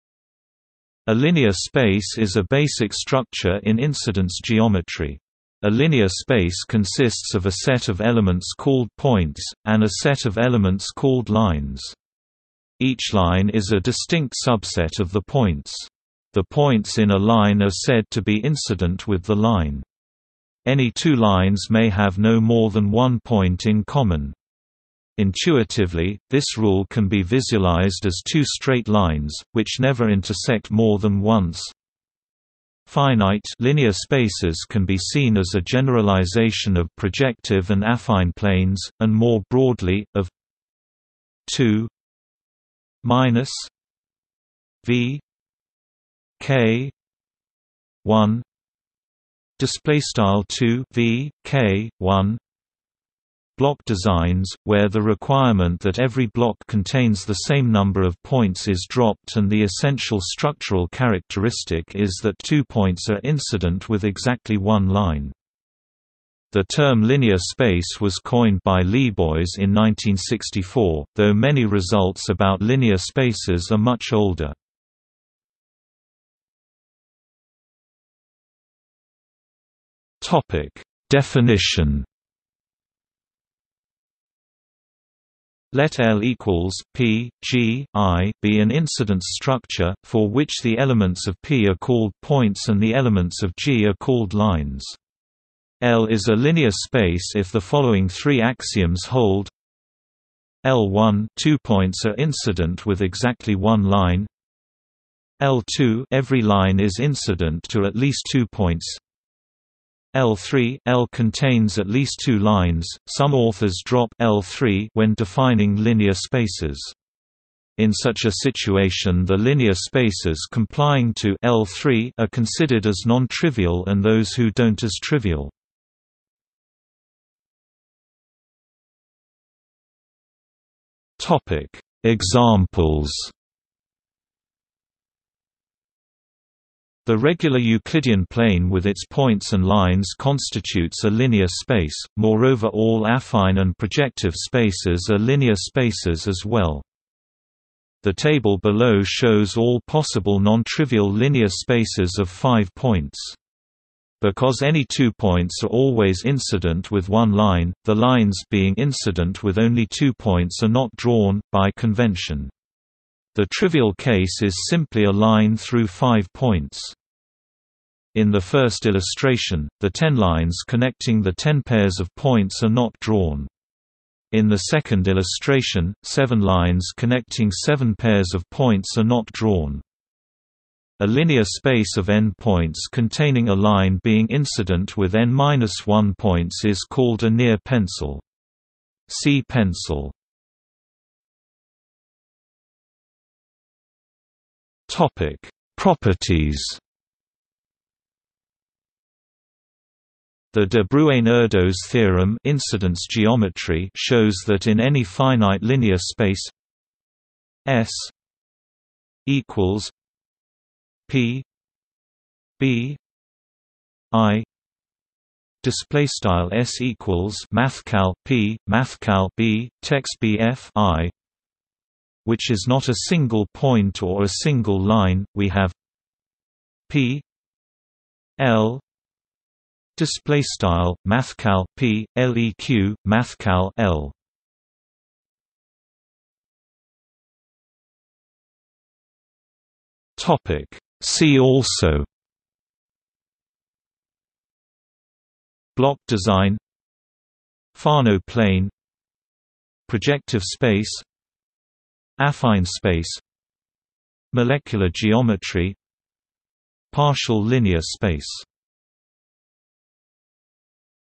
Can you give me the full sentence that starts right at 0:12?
Each line is a distinct subset of the points.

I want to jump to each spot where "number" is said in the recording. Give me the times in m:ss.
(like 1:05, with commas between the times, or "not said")
0:57.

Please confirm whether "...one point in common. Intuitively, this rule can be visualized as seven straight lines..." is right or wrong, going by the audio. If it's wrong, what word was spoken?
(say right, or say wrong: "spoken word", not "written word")
wrong: "two", not "seven".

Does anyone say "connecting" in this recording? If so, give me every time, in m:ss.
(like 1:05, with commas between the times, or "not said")
2:50, 2:56.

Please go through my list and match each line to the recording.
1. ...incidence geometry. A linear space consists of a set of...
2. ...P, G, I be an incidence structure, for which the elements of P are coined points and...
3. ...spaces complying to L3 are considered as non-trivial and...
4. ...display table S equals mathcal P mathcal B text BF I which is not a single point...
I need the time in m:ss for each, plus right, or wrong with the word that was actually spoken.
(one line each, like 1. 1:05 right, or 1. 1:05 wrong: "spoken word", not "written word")
1. 0:03 right
2. 1:26 wrong: "called", not "coined"
3. 1:59 right
4. 3:35 wrong: "style", not "table".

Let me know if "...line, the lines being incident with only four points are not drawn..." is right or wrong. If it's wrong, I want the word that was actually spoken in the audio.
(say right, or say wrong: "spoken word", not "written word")
wrong: "two", not "four".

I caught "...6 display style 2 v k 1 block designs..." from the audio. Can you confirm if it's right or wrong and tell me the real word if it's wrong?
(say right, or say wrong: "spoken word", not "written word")
wrong: "1", not "6".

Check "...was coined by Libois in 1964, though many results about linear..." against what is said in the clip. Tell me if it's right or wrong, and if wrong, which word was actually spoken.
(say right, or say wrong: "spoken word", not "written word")
right.